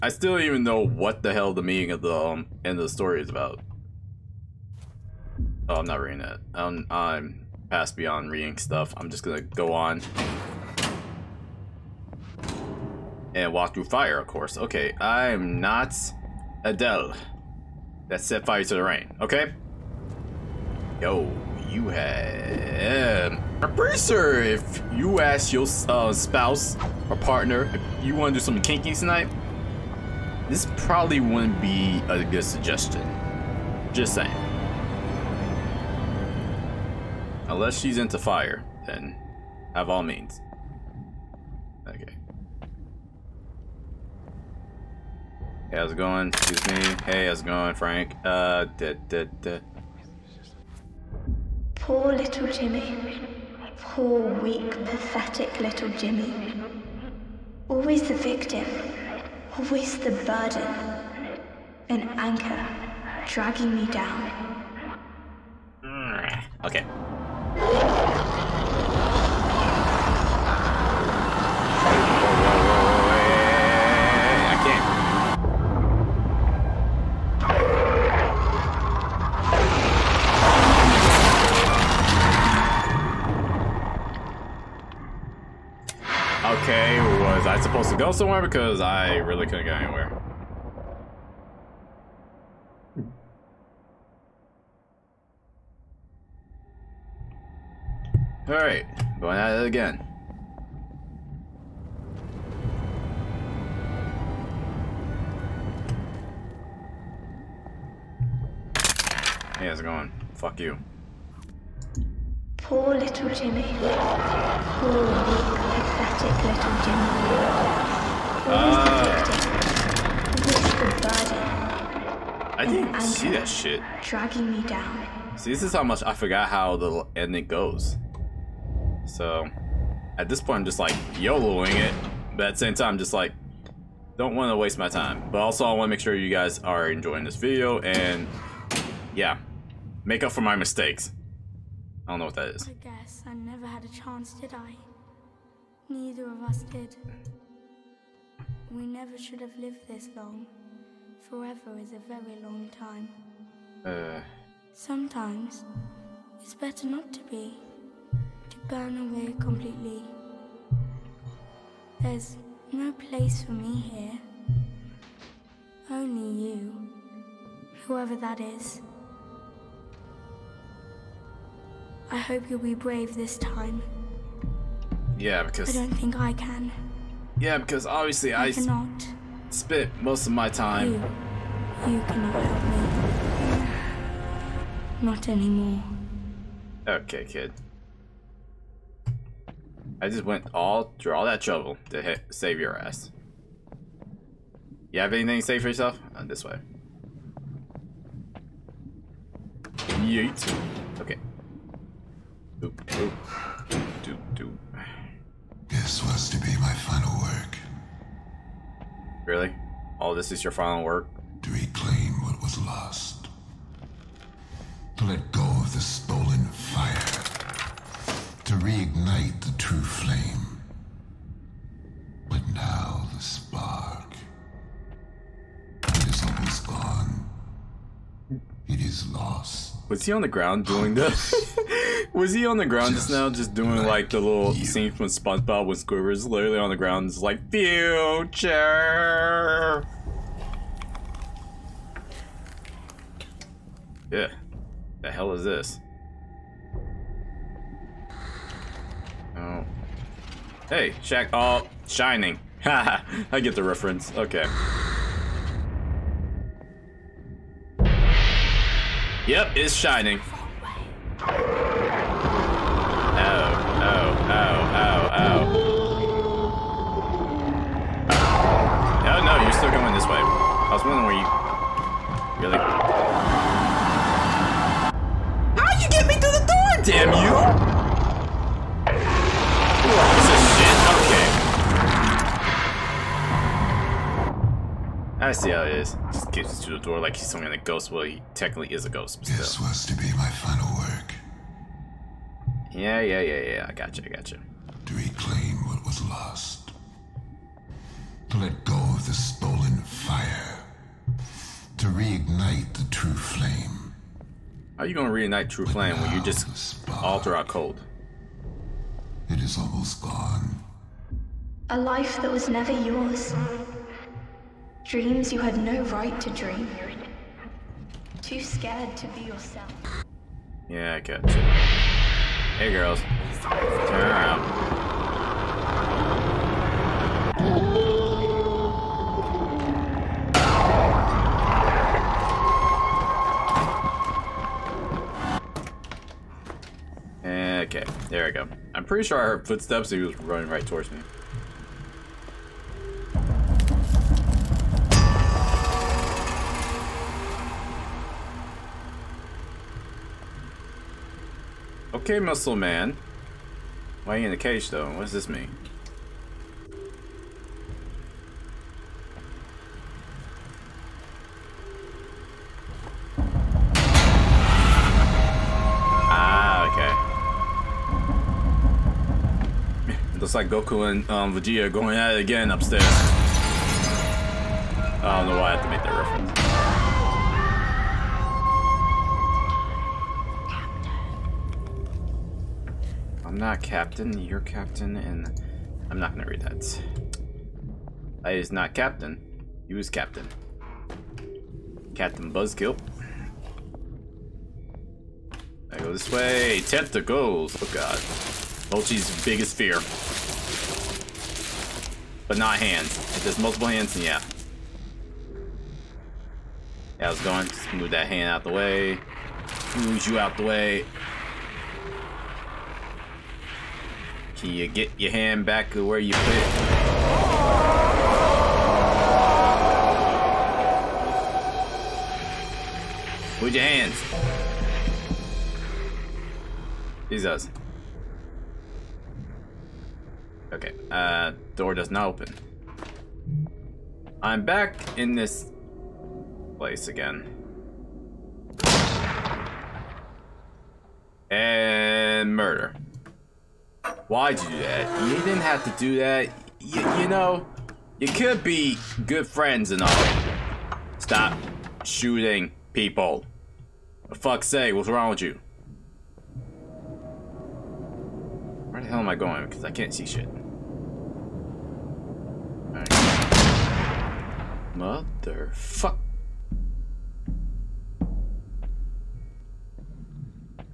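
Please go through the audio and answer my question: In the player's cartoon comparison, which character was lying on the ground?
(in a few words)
Squidward.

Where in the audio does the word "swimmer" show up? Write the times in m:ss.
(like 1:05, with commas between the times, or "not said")
not said.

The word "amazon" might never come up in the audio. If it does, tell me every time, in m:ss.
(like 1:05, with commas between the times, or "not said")
not said.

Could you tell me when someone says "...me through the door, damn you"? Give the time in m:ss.
4:36.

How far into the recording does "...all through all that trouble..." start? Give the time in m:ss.
3:10.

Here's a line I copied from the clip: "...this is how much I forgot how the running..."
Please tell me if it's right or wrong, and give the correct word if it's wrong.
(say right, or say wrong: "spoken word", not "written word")
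wrong: "ending", not "running".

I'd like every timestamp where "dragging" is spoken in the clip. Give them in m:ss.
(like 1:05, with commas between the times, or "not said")
1:03, 2:04.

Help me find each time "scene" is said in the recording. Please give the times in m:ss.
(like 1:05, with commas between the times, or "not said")
3:54.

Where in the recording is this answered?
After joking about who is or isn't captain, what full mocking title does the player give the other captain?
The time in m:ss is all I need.
6:31.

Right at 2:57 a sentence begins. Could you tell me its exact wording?
Yeah, because obviously I, I cannot.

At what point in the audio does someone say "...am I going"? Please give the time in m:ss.
7:38.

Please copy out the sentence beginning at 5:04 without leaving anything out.
How are you gonna reignite true but flame when you just spark, alter our code?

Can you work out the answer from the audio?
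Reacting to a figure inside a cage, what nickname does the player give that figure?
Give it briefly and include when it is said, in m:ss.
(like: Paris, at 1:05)
Muscle Man, at 5:52.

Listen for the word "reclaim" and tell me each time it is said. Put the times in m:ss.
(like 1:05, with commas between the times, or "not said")
3:31, 4:54.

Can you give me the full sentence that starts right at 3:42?
But now the spark it is gone.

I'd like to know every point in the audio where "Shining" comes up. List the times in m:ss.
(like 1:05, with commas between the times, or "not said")
4:11, 4:19.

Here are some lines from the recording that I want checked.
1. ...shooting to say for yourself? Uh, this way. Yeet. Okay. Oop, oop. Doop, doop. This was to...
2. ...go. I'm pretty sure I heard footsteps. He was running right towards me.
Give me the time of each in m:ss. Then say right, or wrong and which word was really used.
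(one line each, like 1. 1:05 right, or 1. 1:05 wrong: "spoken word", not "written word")
1. 3:15 wrong: "anything", not "shooting"
2. 5:38 right.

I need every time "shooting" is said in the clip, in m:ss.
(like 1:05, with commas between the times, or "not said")
7:31.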